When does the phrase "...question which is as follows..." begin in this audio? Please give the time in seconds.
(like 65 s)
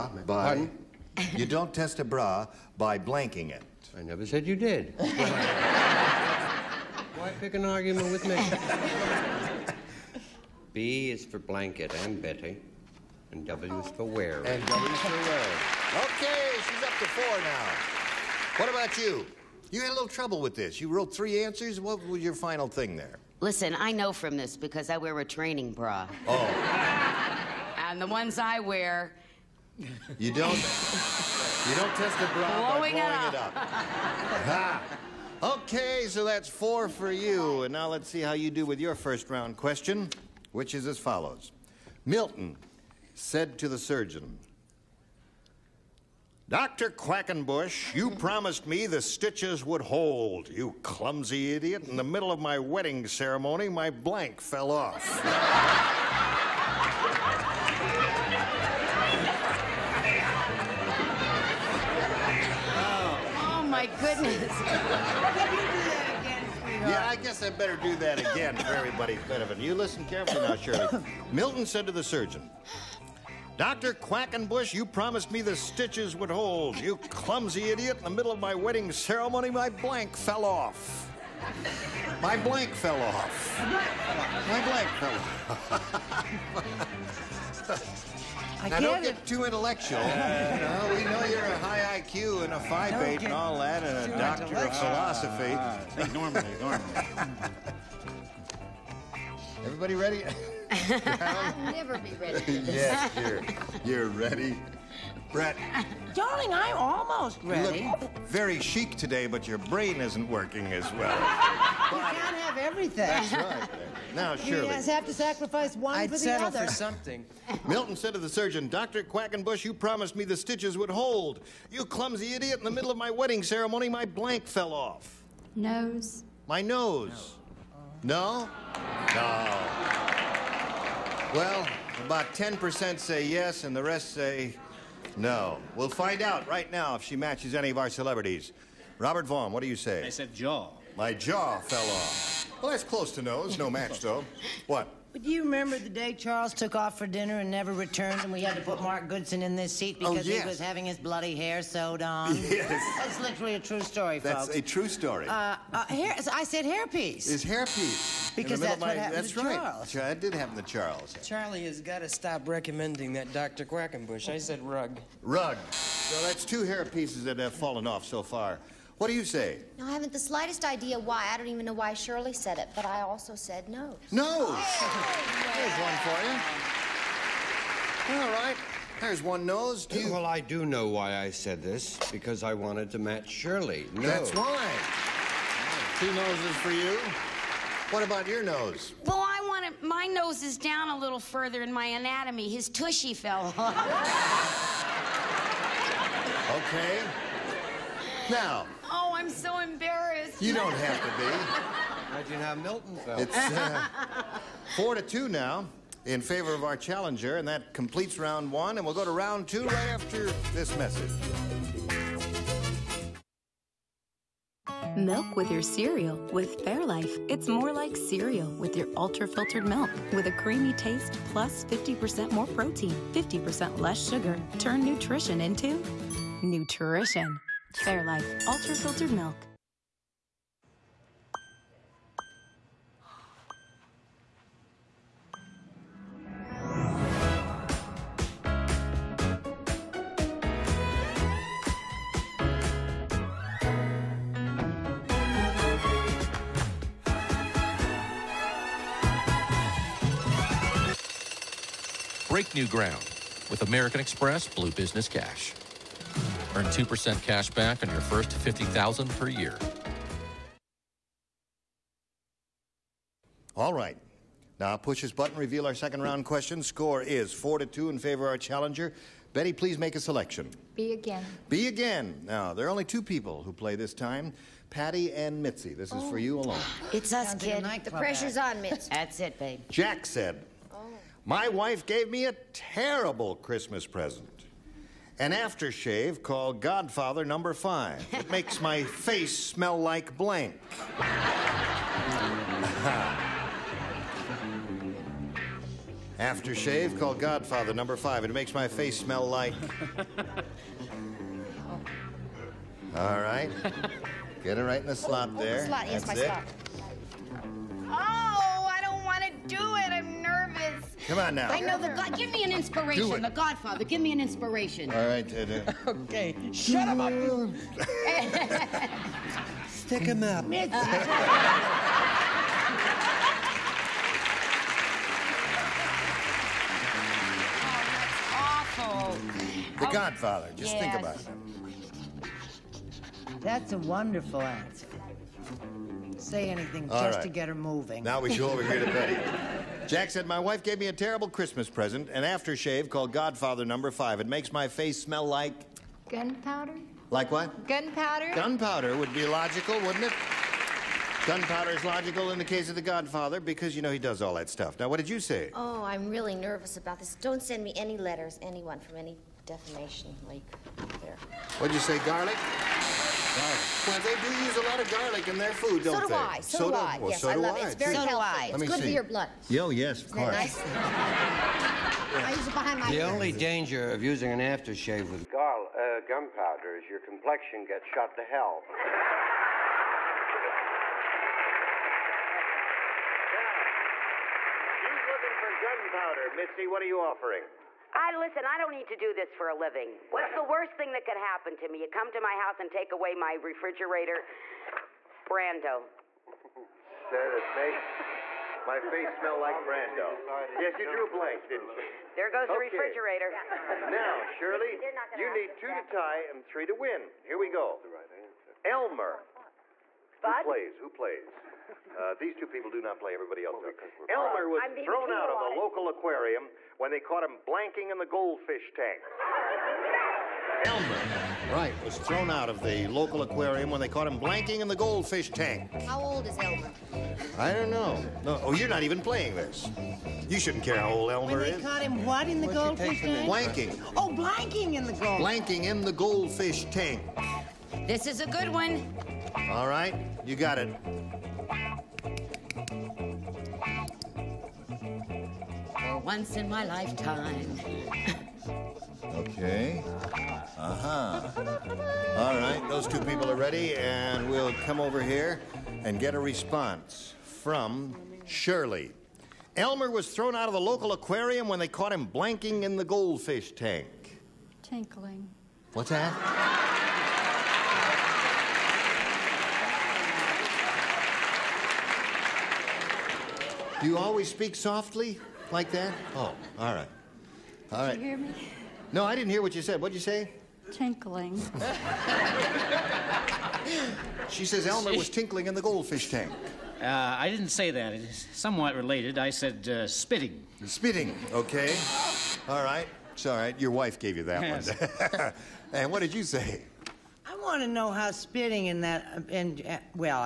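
39 s.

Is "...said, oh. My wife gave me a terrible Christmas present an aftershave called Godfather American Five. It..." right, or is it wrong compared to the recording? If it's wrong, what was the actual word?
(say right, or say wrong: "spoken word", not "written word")
wrong: "Number", not "American".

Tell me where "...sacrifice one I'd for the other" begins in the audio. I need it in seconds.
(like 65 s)
115 s.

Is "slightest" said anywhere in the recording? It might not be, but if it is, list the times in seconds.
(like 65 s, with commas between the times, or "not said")
170 s.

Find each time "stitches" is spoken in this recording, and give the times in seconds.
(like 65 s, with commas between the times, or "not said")
49 s, 75 s, 120 s.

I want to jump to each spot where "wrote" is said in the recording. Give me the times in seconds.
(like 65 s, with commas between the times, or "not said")
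20 s.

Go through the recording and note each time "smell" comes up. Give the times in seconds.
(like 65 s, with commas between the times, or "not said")
289 s, 298 s, 345 s, 399 s.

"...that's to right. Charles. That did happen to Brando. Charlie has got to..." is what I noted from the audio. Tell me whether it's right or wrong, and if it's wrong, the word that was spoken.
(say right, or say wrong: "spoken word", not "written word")
wrong: "Charles", not "Brando".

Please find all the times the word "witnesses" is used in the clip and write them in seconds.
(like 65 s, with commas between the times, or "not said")
not said.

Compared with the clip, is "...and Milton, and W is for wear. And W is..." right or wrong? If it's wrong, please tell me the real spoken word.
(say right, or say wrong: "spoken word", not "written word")
wrong: "Betty", not "Milton".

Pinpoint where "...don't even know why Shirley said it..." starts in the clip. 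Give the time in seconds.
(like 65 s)
171 s.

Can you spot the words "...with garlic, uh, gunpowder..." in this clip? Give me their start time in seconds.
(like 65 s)
375 s.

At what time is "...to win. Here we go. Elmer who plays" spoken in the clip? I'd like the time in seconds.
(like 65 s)
406 s.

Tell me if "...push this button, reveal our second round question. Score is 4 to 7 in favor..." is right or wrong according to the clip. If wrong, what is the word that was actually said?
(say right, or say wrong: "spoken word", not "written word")
wrong: "2", not "7".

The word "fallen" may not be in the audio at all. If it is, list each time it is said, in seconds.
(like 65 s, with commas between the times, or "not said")
167 s.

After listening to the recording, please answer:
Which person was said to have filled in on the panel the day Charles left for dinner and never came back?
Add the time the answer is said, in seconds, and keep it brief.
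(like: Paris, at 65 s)
Mark Goodson, at 148 s.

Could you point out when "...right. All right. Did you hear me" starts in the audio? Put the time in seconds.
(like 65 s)
476 s.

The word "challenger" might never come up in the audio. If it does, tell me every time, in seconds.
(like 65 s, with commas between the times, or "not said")
206 s, 268 s.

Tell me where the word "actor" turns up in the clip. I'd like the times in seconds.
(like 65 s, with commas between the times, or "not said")
not said.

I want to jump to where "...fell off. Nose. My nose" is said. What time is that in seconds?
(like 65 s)
124 s.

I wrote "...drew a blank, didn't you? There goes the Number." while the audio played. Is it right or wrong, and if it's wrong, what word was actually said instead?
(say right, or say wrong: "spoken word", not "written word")
wrong: "Okay", not "Number".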